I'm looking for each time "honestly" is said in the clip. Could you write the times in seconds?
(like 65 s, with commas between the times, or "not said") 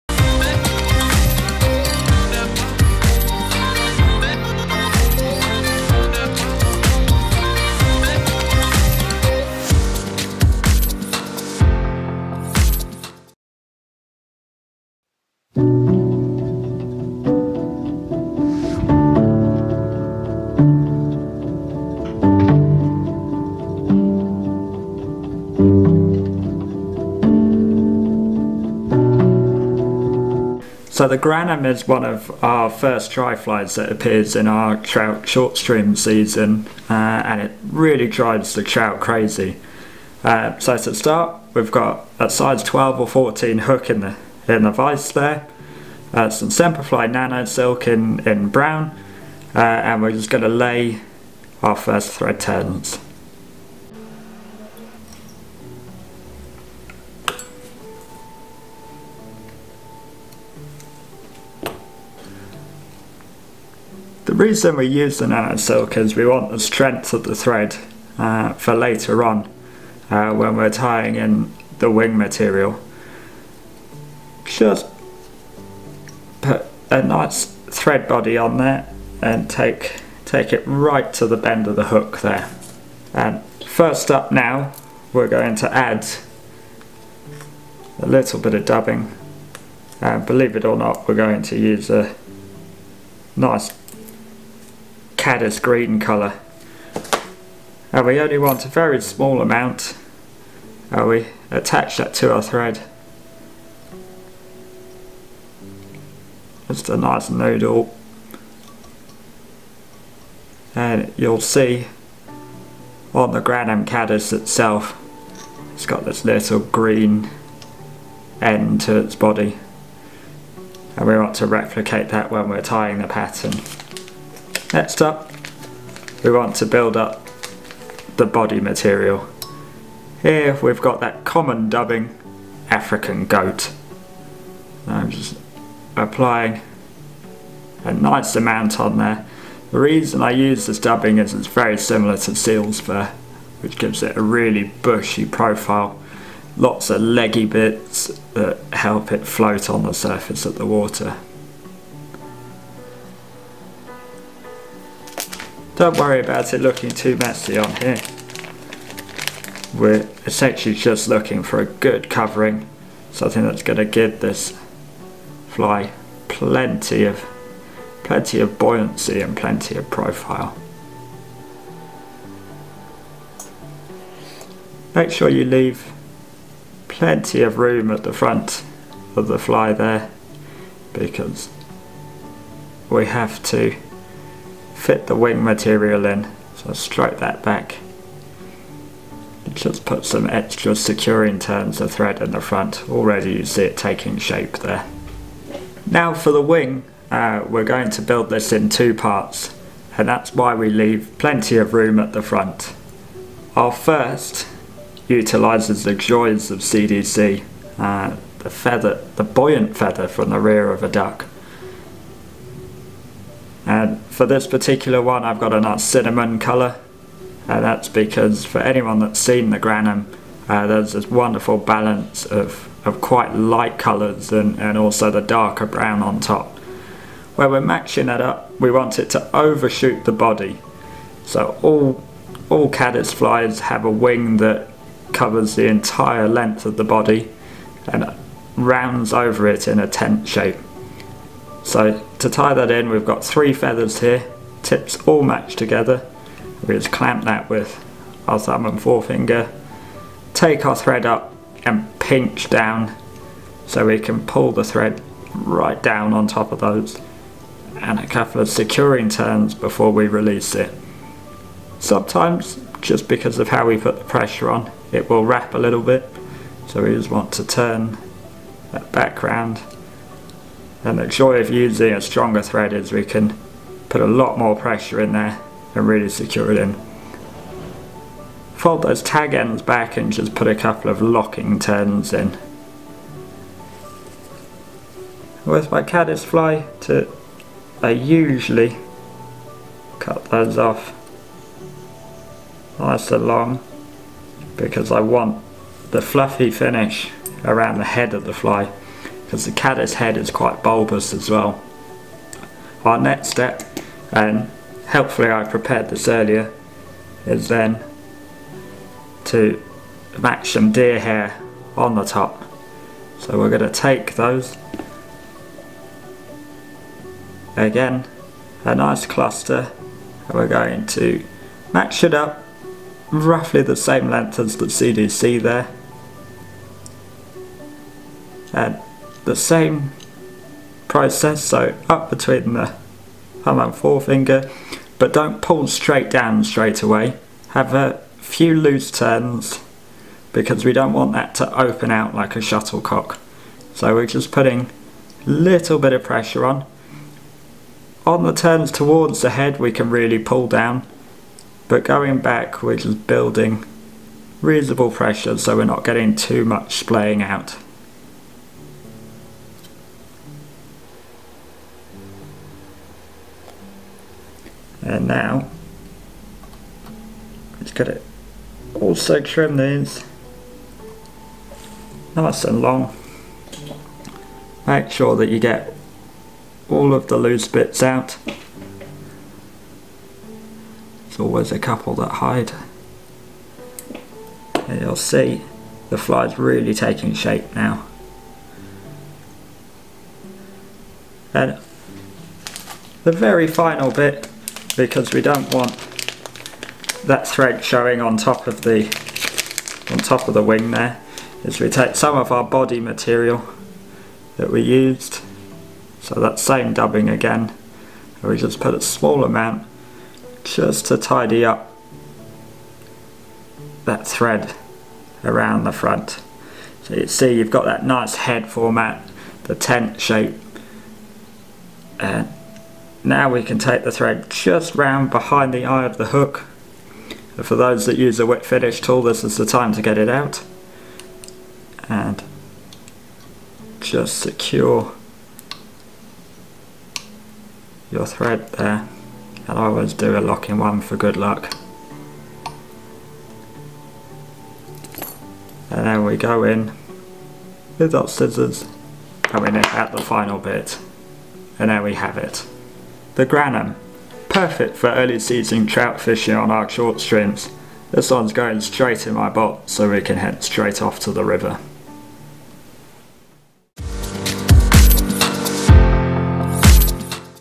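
not said.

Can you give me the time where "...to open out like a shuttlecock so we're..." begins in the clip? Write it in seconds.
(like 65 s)
341 s.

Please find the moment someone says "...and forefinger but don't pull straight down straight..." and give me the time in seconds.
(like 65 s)
333 s.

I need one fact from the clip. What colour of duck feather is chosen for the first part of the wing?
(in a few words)
cinnamon.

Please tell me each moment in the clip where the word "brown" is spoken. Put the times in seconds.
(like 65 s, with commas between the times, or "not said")
48 s, 225 s.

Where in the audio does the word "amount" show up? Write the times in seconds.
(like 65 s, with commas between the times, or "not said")
99 s, 138 s, 409 s.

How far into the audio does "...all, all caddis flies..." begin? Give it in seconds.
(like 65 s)
231 s.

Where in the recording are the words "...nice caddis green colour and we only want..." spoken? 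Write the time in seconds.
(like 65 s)
93 s.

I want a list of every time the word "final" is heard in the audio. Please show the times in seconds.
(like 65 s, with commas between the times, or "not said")
393 s, 450 s.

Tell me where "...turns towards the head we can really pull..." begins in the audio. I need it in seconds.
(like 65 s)
348 s.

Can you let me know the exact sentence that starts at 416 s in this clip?
So you see you've got that nice head format, the tent shape.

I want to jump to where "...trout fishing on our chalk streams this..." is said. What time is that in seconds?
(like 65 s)
455 s.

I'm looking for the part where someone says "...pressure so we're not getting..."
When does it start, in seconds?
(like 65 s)
354 s.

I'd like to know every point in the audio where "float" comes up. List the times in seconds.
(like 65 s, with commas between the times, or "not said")
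149 s.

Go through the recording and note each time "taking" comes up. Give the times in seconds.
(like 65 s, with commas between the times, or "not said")
193 s, 386 s.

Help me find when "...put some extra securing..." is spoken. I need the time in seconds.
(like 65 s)
189 s.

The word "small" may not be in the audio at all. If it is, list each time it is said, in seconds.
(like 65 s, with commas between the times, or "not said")
99 s, 408 s.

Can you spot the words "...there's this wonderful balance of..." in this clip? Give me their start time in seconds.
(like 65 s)
220 s.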